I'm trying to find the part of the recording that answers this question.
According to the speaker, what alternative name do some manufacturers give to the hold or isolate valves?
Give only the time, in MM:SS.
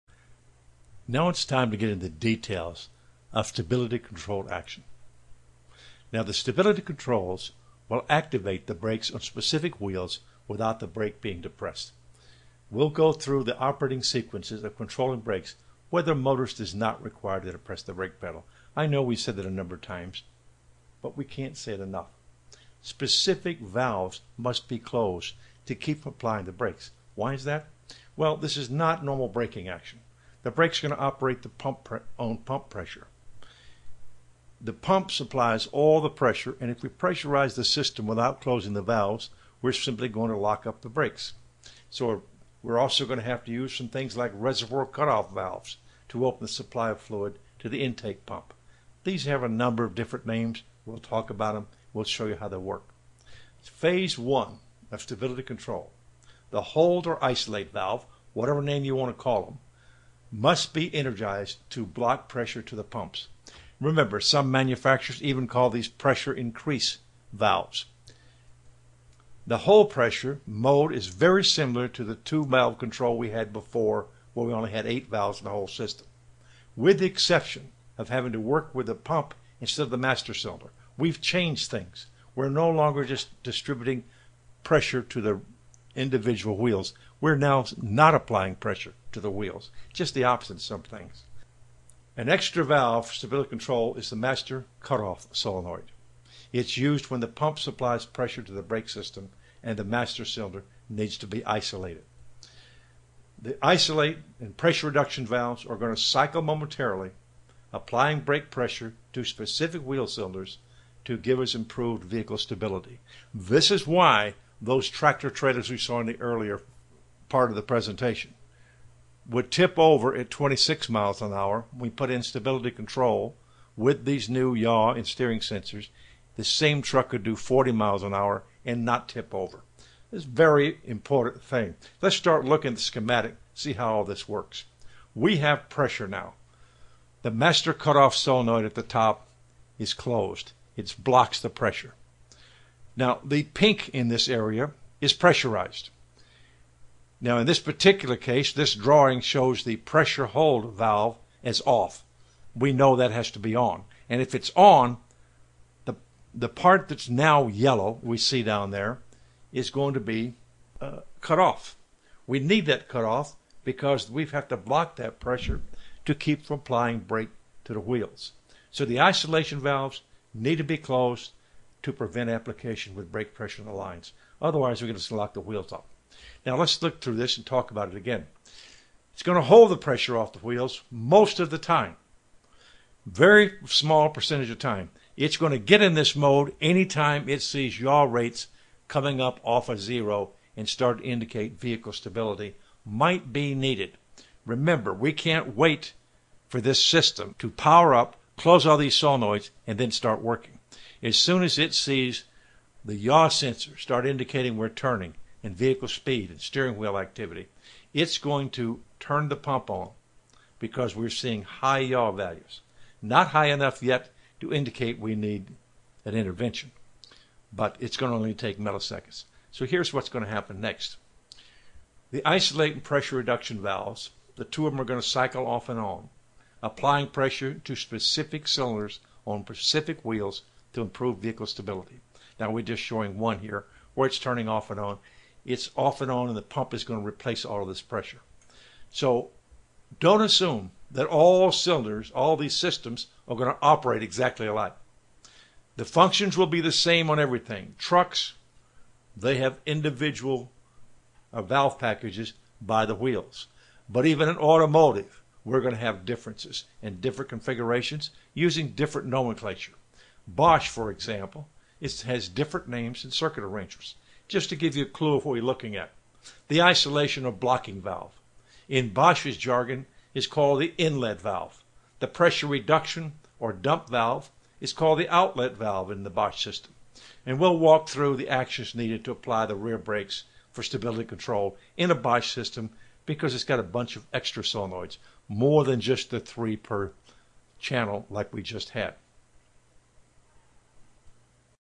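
01:05.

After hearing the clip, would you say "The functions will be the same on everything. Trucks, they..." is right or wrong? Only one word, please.
right.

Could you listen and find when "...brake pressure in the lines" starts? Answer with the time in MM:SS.
02:53.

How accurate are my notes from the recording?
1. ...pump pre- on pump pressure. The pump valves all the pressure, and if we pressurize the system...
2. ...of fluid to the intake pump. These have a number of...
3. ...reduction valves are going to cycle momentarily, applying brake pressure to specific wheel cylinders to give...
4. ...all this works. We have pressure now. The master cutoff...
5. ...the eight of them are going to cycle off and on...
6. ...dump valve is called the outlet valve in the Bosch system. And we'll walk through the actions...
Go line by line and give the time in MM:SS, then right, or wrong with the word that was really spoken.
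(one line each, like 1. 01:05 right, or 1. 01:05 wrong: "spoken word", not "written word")
1. 00:31 wrong: "supplies", not "valves"
2. 00:46 right
3. 01:44 right
4. 02:13 right
5. 03:44 wrong: "two", not "eight"
6. 04:33 right.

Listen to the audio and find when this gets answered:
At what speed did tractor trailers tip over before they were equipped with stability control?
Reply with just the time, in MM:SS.
02:00.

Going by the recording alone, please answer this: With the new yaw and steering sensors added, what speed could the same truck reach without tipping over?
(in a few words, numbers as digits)
40 miles an hour.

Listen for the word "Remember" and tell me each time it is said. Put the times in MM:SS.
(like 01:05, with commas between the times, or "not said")
01:03, 03:14.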